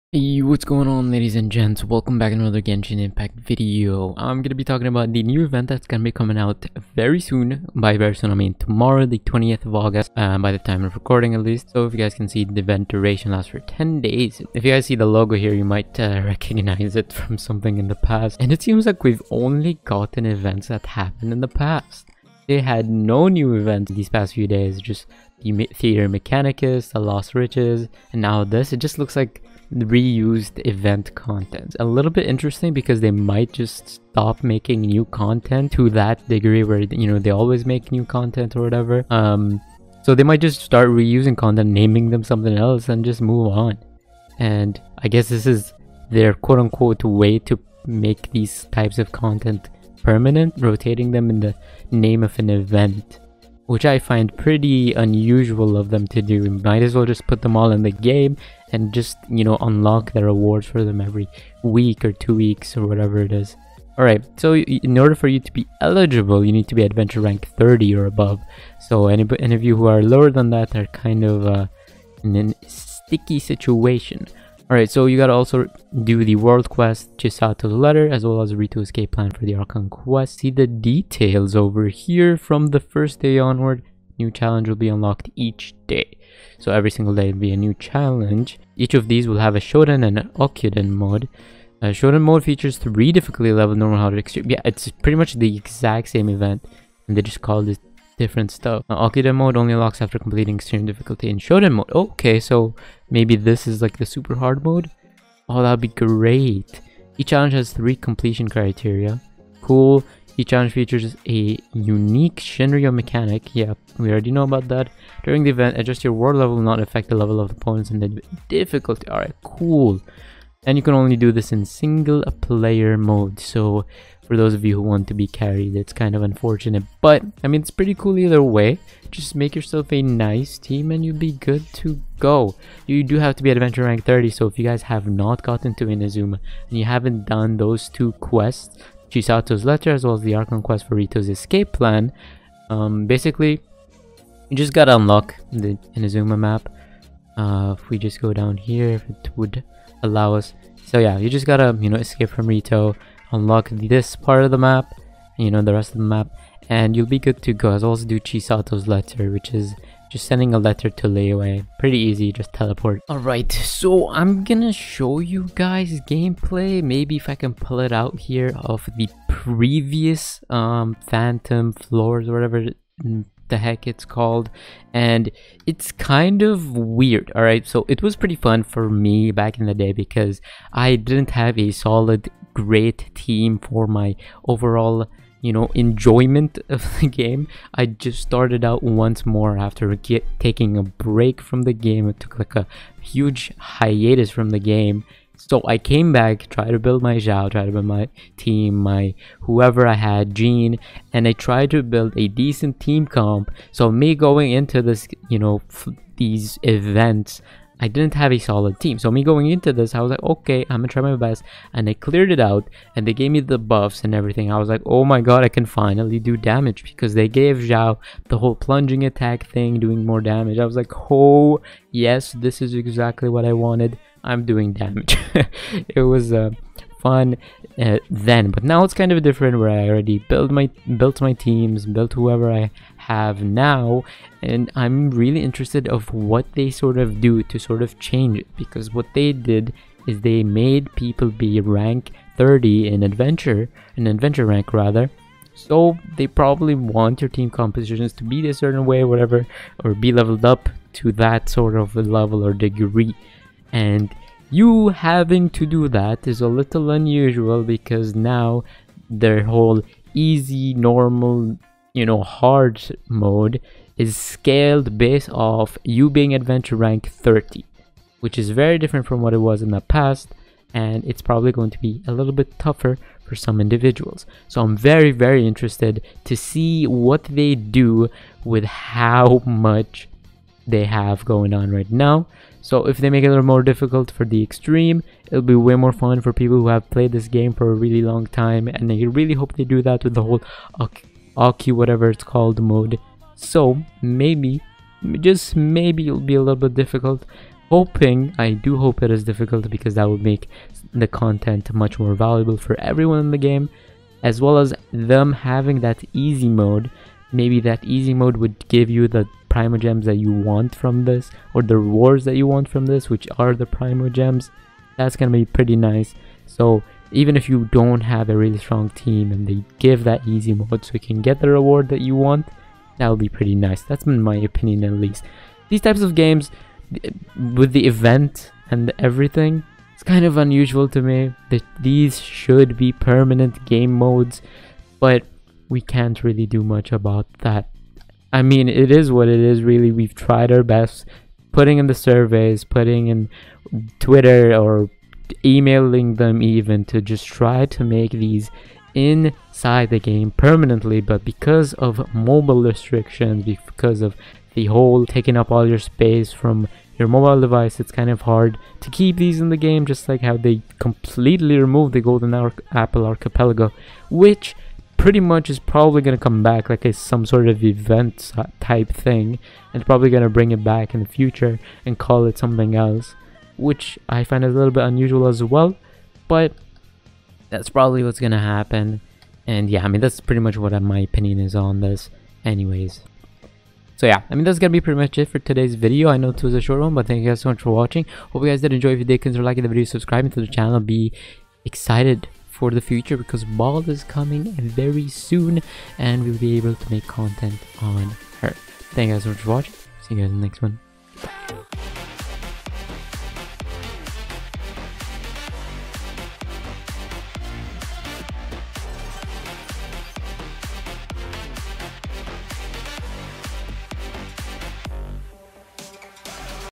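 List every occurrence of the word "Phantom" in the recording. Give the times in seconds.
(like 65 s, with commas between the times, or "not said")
171 s.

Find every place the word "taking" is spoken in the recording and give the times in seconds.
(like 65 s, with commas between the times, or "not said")
190 s, 355 s.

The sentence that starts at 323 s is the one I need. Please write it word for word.
That's been my opinion at least.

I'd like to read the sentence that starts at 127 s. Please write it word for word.
But, I mean, it's pretty cool either way.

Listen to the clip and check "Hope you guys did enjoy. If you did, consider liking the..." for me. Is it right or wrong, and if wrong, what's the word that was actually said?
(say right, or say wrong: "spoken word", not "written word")
right.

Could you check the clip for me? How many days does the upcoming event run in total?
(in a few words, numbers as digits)
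10.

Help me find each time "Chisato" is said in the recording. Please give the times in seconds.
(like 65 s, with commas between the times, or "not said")
77 s, 139 s, 158 s.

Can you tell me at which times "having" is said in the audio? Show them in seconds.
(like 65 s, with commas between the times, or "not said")
254 s, 305 s.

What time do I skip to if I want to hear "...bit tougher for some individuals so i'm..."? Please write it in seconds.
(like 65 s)
272 s.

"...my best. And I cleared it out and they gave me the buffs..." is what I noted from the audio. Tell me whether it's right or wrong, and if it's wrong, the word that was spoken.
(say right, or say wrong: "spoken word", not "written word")
right.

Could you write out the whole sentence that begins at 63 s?
Alright, so in order for you to be eligible, you need to be adventure rank 30 or above.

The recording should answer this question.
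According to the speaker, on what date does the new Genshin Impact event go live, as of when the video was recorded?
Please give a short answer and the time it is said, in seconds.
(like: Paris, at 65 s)
20th of August, at 9 s.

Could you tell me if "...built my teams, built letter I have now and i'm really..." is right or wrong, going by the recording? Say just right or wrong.
wrong.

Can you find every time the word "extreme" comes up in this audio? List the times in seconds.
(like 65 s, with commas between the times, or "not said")
94 s, 100 s, 284 s.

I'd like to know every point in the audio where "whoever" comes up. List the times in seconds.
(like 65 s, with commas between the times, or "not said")
199 s, 232 s.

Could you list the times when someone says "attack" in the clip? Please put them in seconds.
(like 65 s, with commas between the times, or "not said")
219 s.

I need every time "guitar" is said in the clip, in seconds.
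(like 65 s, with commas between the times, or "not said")
not said.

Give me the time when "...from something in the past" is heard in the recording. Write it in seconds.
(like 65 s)
17 s.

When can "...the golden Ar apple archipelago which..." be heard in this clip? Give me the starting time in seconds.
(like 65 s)
361 s.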